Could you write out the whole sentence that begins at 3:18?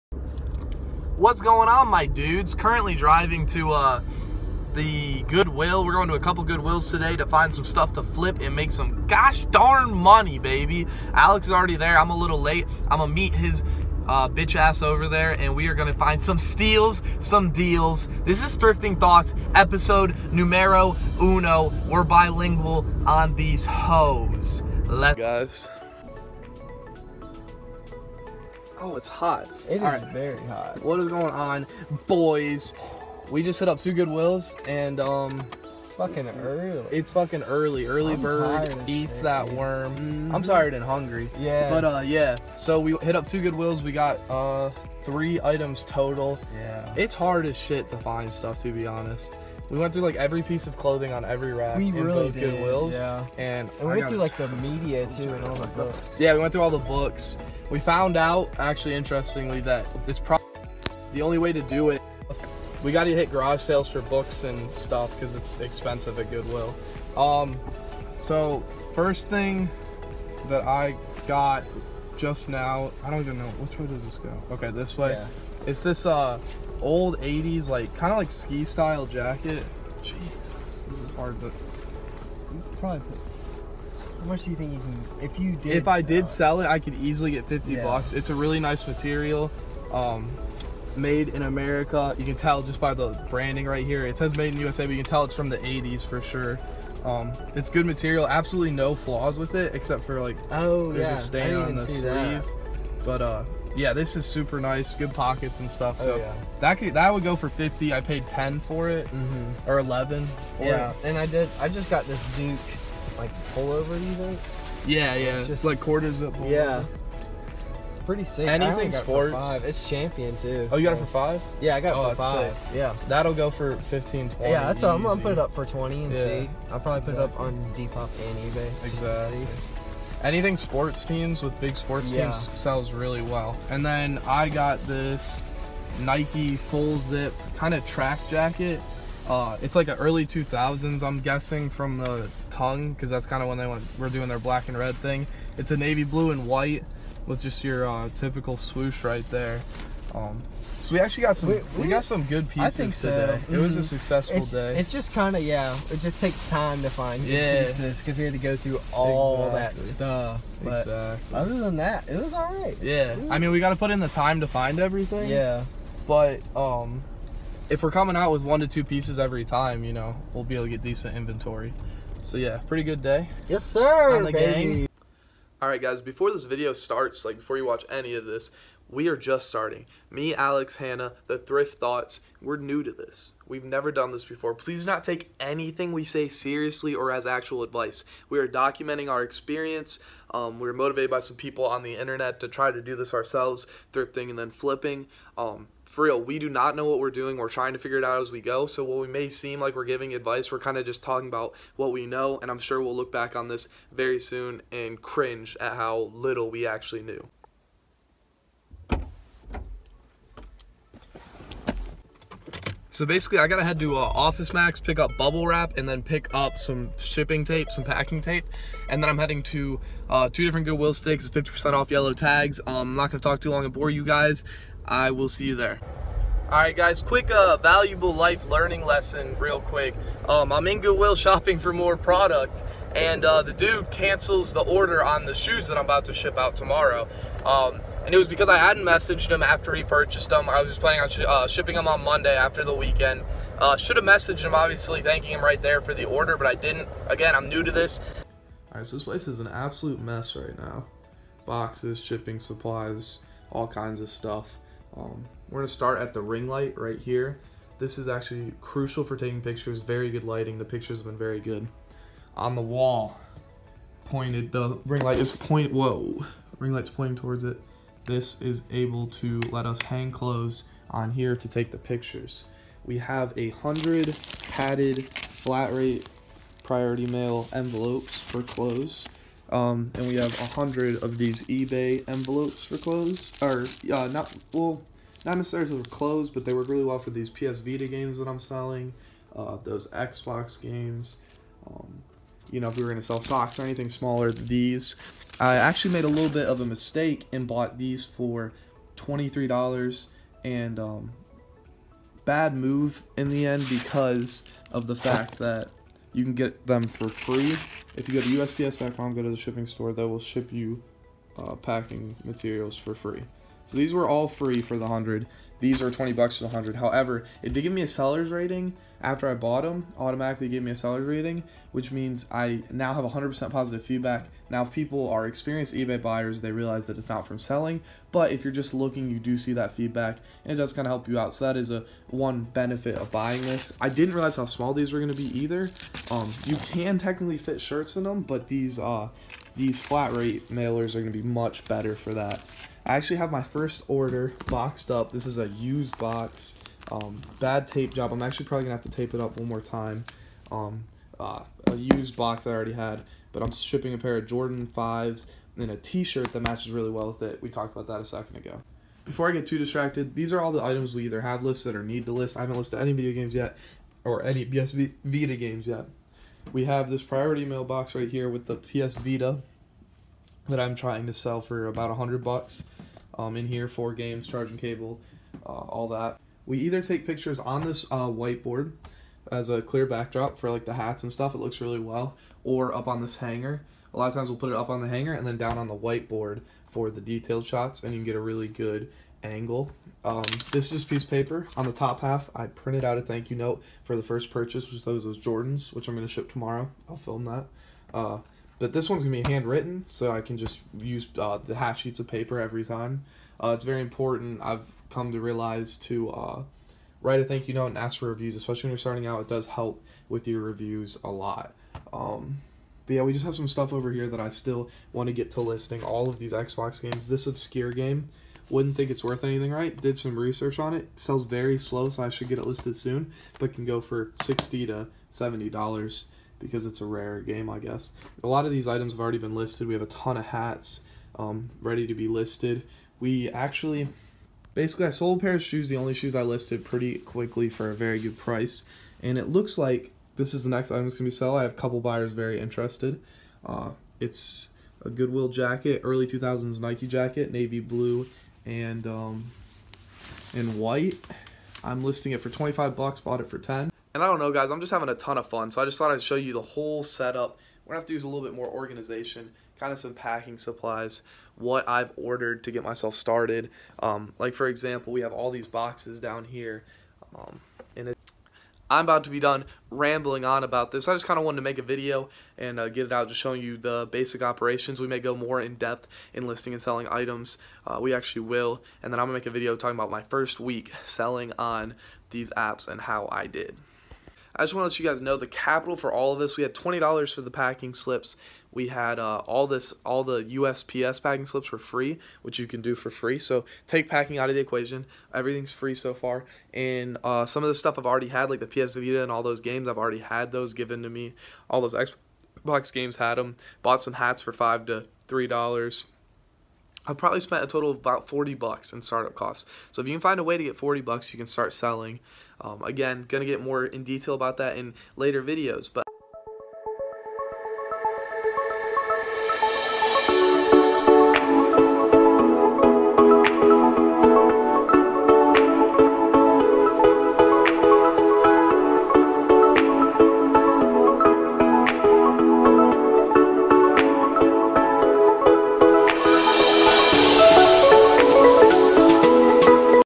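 So while we may seem like we're giving advice, we're kind of just talking about what we know.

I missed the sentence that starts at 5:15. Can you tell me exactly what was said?
These are 20 bucks for the 100.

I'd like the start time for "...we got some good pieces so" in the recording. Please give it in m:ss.
2:31.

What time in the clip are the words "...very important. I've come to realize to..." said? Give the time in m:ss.
6:43.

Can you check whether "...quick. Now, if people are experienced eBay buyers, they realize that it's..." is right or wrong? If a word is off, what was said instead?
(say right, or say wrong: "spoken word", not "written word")
wrong: "feedback", not "quick".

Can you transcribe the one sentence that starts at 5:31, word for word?
So that is a one benefit of buying this.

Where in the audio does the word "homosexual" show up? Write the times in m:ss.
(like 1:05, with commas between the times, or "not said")
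not said.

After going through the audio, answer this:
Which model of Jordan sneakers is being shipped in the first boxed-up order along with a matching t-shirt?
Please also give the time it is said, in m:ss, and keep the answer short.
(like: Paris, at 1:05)
Jordan 5s, at 5:54.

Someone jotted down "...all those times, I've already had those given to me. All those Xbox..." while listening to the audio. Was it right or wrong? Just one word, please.
wrong.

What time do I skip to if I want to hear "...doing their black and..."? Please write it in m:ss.
2:24.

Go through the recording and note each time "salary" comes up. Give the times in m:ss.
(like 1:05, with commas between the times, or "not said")
not said.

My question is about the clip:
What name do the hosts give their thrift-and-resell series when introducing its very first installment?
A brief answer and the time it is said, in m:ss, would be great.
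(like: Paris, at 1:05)
Thrifting Thoughts, at 0:18.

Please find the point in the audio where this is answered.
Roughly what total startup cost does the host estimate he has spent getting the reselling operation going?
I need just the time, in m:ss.
8:27.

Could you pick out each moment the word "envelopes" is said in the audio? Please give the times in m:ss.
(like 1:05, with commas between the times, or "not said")
4:37, 4:42.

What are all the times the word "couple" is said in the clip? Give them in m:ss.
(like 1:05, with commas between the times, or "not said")
0:06, 7:21.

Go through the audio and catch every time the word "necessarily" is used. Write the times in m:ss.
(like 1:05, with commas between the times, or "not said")
4:45.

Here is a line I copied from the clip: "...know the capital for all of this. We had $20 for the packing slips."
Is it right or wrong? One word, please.
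right.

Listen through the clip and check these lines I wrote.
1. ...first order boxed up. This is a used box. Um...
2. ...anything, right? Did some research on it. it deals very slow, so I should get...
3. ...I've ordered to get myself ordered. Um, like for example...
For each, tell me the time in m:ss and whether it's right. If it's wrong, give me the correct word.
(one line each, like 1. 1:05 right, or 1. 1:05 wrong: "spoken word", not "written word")
1. 5:43 right
2. 6:59 wrong: "sells", not "deals"
3. 7:41 wrong: "started", not "ordered".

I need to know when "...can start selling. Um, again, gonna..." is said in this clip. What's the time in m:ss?
8:31.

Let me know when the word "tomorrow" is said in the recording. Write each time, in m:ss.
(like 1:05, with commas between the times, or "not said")
3:56, 6:36.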